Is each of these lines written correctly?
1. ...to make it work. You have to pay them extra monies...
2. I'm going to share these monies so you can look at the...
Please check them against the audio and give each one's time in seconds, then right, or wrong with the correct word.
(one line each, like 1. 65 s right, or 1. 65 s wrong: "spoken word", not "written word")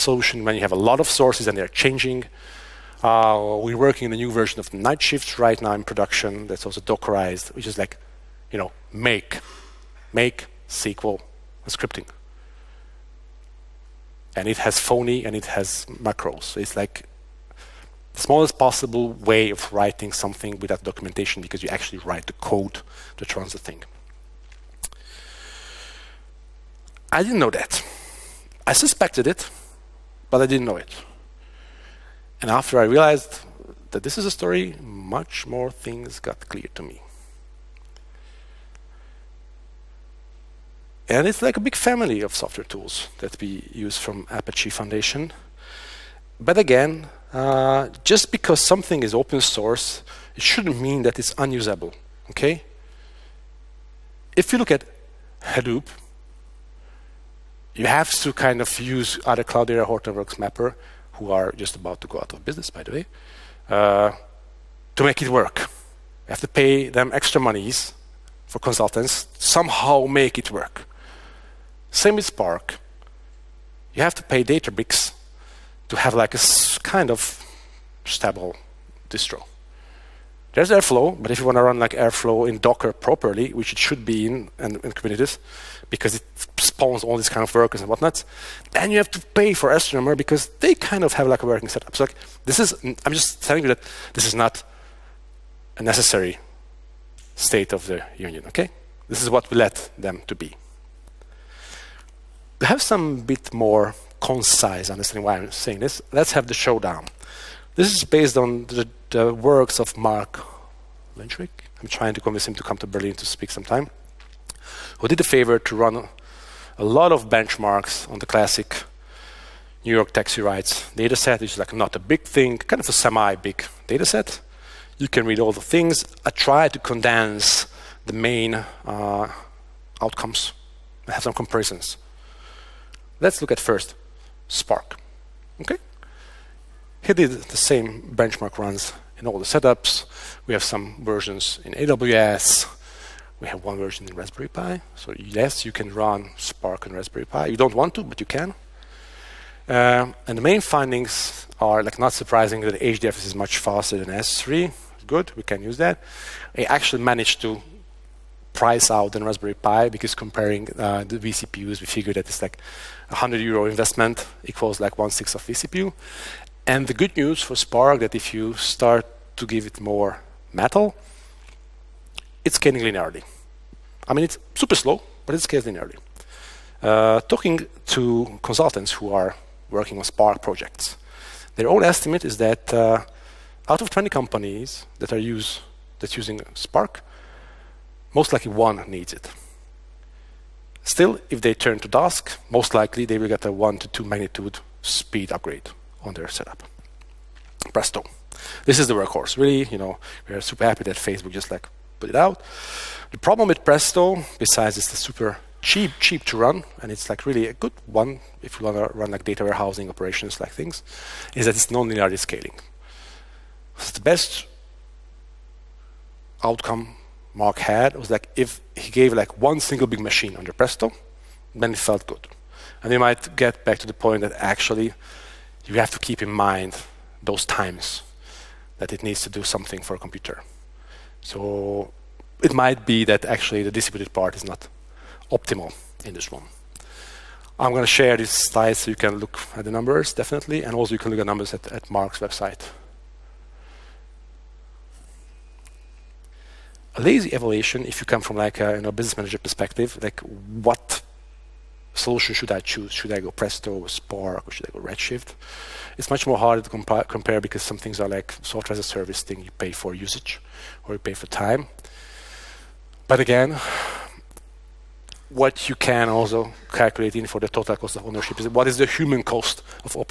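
1. 64 s right
2. 237 s wrong: "slides", not "monies".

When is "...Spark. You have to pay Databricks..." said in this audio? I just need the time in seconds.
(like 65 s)
72 s.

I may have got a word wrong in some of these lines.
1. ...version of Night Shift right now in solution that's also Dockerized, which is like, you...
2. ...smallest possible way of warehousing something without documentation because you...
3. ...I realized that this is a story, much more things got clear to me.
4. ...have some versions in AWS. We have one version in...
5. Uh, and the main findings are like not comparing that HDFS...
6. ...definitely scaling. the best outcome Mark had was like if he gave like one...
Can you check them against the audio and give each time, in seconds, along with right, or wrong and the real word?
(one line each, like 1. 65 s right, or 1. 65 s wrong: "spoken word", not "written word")
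1. 4 s wrong: "production", not "solution"
2. 18 s wrong: "writing", not "warehousing"
3. 32 s right
4. 140 s right
5. 149 s wrong: "surprising", not "comparing"
6. 211 s wrong: "nonlinearly", not "definitely".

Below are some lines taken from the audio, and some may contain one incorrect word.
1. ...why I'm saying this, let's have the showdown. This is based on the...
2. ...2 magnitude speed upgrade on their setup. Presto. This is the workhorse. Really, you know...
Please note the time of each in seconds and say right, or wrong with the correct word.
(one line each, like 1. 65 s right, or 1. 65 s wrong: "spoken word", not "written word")
1. 105 s right
2. 193 s right.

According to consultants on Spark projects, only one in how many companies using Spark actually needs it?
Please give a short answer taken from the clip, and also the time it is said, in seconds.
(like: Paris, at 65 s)
20, at 183 s.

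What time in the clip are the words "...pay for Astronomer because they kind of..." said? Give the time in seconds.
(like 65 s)
89 s.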